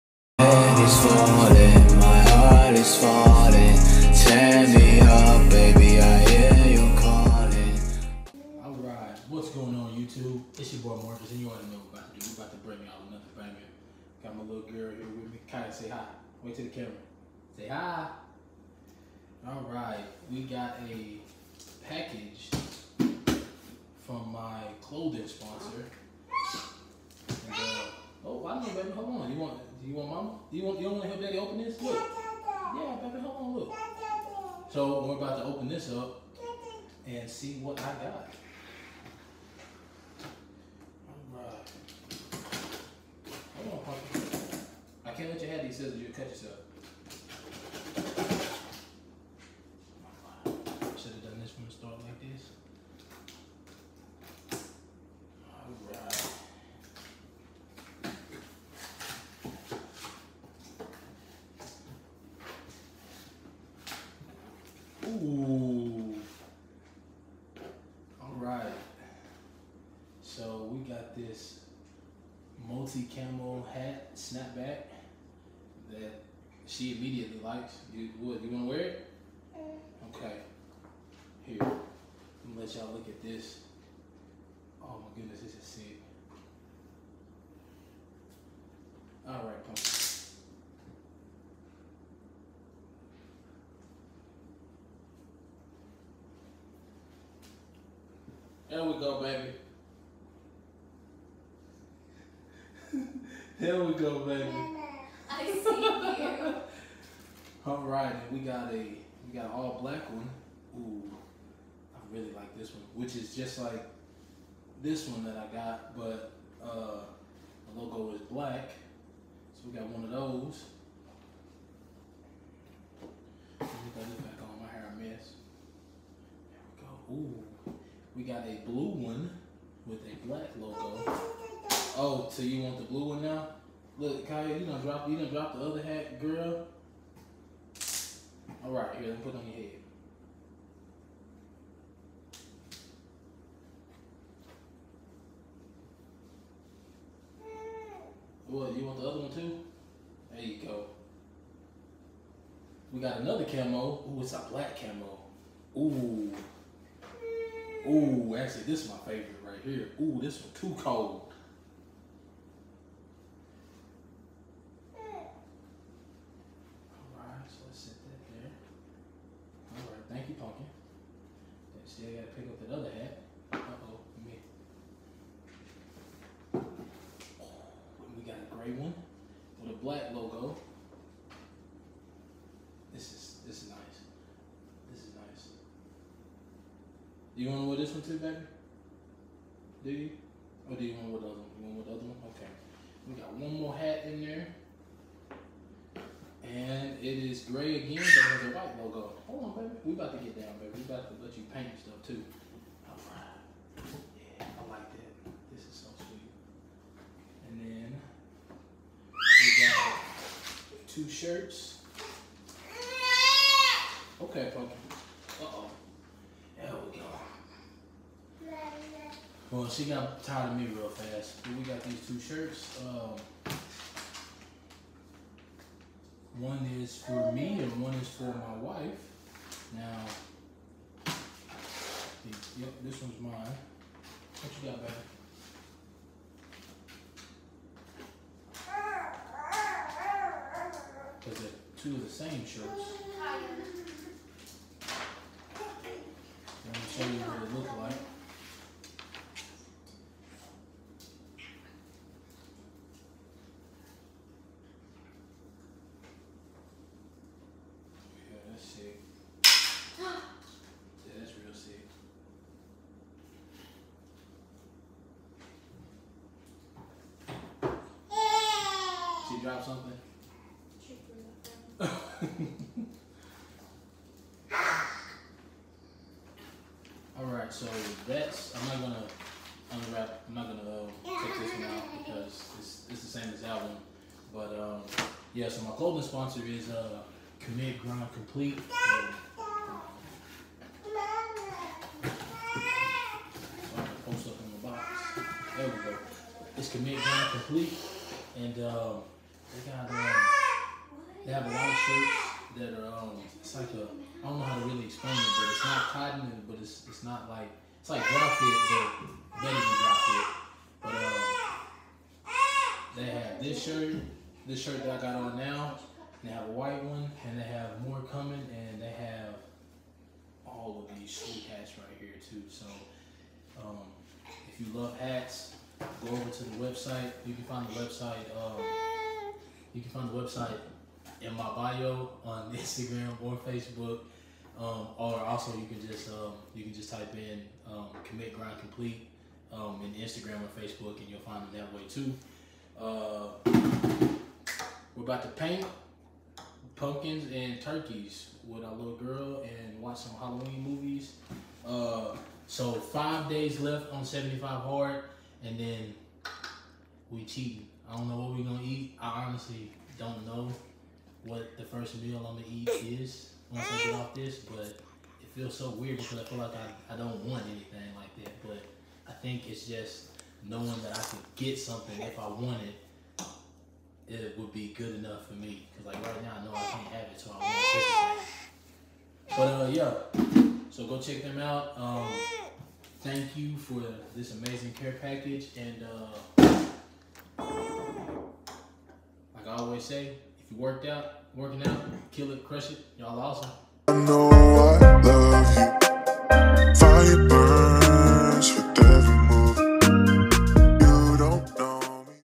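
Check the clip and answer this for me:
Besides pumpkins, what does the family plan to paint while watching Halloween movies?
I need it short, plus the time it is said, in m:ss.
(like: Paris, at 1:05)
turkeys, at 5:47.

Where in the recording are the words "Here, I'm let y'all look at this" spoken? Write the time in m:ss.
1:21.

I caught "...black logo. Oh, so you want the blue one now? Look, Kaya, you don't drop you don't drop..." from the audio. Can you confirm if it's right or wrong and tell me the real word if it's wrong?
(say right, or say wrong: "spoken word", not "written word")
right.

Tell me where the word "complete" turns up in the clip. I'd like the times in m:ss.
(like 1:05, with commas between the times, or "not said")
4:48, 4:57, 5:38.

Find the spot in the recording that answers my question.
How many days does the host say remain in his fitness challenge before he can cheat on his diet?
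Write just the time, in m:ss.
5:52.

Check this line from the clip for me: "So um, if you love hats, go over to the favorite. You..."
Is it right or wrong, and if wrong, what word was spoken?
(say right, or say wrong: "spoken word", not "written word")
wrong: "website", not "favorite".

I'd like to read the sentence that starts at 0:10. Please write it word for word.
It's your boy Marcus, and you already know what we're about to do.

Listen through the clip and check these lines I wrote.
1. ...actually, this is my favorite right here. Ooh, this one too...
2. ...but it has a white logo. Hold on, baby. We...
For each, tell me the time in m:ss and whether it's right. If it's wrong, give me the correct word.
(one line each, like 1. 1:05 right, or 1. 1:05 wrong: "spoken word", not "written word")
1. 2:38 right
2. 3:17 right.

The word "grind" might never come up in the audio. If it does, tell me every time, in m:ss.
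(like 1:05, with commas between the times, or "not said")
4:47, 4:56, 5:38.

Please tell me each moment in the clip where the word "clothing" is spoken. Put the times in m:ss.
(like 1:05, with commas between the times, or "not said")
0:24, 4:45.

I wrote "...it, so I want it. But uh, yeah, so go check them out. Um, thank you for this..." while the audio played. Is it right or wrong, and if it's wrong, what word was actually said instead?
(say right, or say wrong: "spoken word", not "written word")
right.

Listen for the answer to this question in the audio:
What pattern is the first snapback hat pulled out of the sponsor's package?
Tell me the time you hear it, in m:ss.
1:12.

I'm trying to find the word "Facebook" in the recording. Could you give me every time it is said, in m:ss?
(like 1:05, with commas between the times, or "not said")
5:33, 5:40.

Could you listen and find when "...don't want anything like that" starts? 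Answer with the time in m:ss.
6:06.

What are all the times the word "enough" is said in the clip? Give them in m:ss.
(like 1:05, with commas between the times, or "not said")
6:14.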